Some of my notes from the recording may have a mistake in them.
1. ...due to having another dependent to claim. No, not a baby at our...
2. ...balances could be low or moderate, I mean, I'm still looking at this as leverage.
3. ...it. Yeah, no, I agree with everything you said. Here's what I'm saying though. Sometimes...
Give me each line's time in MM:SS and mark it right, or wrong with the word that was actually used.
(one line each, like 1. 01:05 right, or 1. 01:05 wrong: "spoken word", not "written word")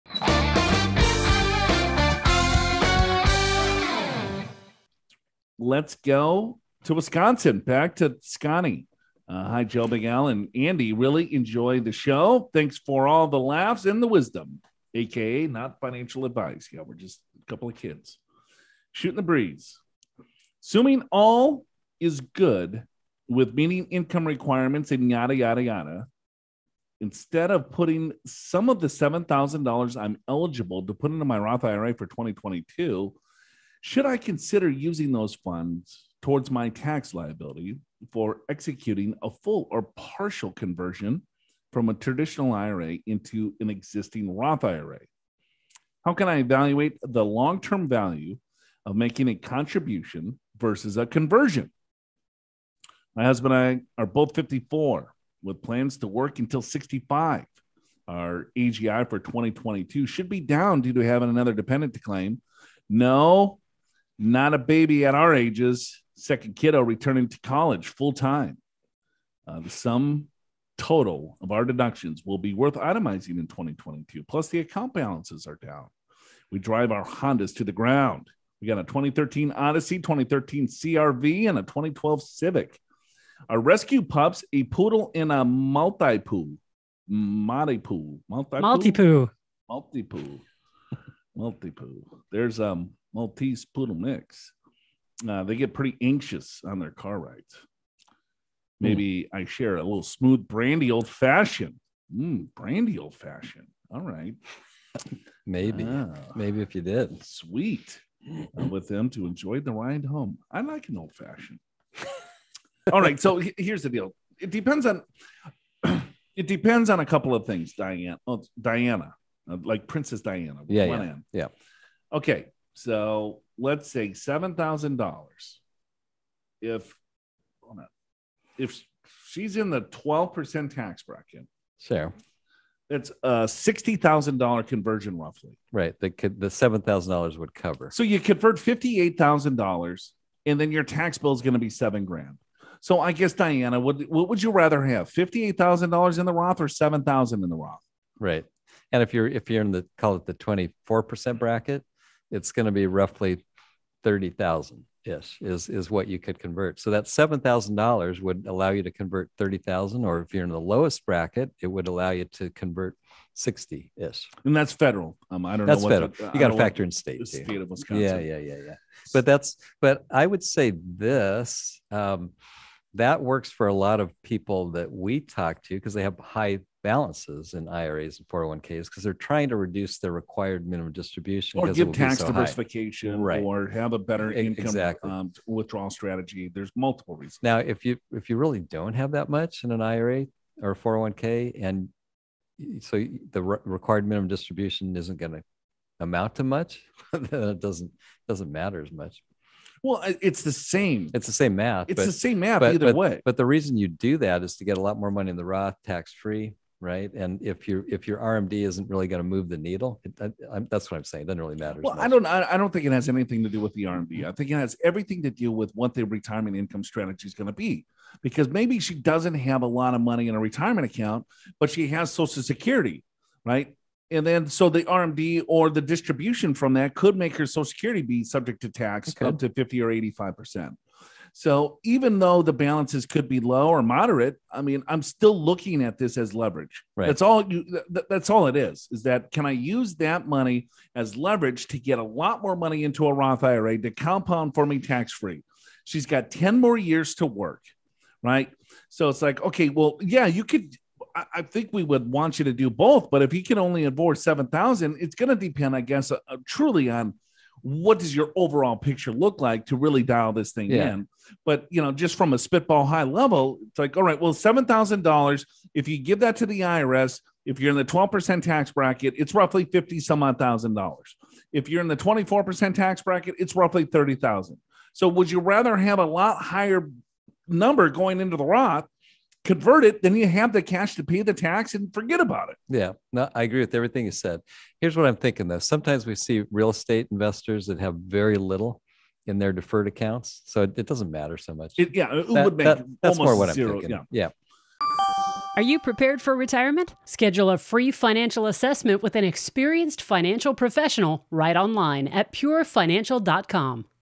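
1. 01:00 right
2. 03:52 right
3. 04:42 wrong: "thinking", not "saying".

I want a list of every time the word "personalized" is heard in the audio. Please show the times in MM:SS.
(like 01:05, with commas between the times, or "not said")
not said.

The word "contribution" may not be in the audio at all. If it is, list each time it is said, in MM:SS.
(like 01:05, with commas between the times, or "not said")
00:49.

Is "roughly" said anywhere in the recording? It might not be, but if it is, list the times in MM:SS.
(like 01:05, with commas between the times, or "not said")
02:15, 02:32, 04:29, 04:33.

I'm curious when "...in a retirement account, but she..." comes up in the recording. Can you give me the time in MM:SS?
03:40.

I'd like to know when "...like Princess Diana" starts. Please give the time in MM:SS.
01:59.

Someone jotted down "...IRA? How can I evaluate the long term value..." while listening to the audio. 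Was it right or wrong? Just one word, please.
right.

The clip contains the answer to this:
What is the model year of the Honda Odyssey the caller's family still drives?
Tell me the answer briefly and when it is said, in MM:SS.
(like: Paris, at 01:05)
2013, at 01:18.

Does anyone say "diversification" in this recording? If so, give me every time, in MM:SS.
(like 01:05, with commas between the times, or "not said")
03:02.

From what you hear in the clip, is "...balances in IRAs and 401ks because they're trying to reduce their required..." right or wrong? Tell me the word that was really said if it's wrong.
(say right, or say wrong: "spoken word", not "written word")
right.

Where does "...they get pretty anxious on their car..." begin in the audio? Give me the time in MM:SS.
01:35.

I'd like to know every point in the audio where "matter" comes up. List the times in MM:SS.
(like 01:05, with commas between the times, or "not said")
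03:18, 03:31, 04:51.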